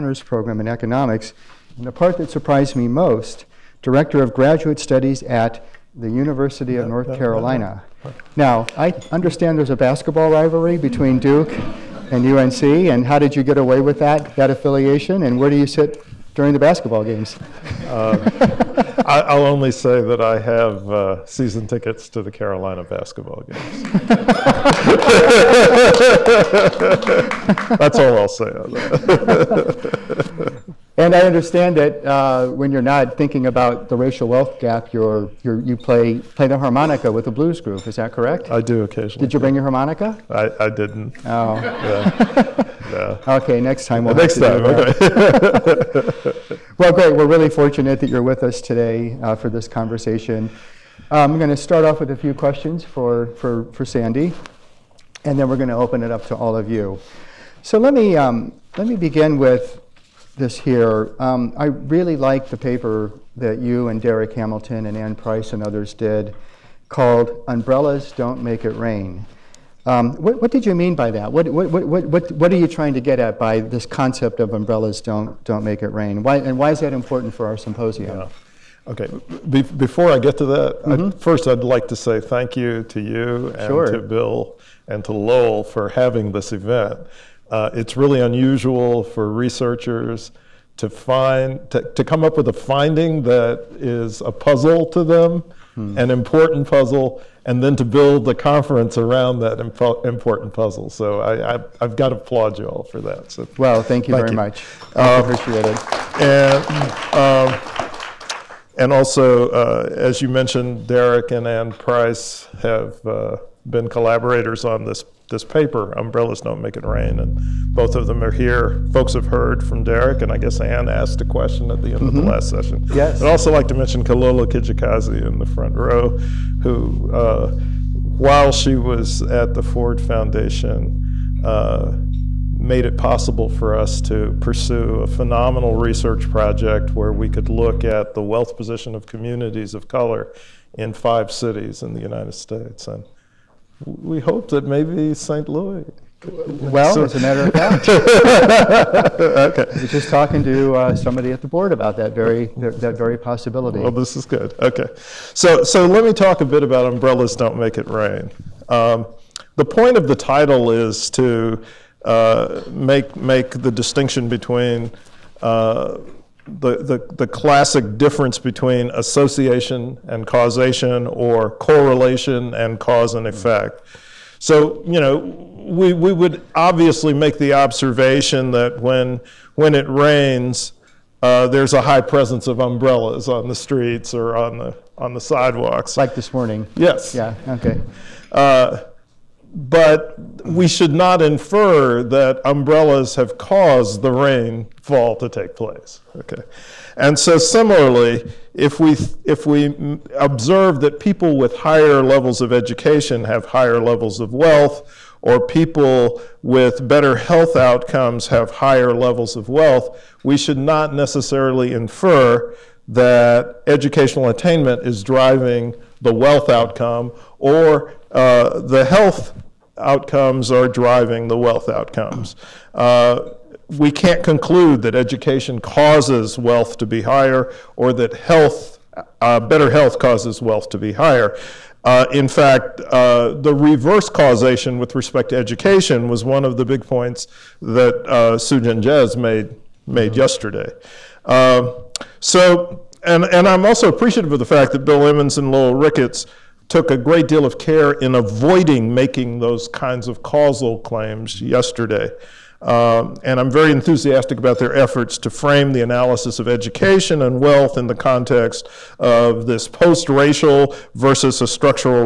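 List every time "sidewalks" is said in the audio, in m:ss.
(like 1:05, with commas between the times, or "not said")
3:05.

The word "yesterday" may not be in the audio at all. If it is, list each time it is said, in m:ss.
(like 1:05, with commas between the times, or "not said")
4:00, 4:11.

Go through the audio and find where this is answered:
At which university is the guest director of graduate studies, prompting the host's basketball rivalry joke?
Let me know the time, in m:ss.
0:06.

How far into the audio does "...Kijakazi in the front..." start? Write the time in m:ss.
2:04.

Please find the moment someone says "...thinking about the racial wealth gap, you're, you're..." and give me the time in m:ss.
0:33.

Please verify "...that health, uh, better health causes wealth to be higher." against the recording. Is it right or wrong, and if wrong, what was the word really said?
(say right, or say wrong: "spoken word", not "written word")
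right.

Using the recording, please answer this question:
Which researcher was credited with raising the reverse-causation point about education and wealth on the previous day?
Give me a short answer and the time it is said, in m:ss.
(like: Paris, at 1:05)
Su Jin Jez, at 3:58.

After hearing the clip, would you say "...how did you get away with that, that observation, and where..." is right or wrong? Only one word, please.
wrong.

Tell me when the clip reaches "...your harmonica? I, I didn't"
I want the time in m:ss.
0:39.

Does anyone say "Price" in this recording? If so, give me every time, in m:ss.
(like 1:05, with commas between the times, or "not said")
1:05, 1:51.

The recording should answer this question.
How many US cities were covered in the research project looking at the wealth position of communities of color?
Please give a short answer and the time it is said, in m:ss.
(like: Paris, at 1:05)
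5, at 2:20.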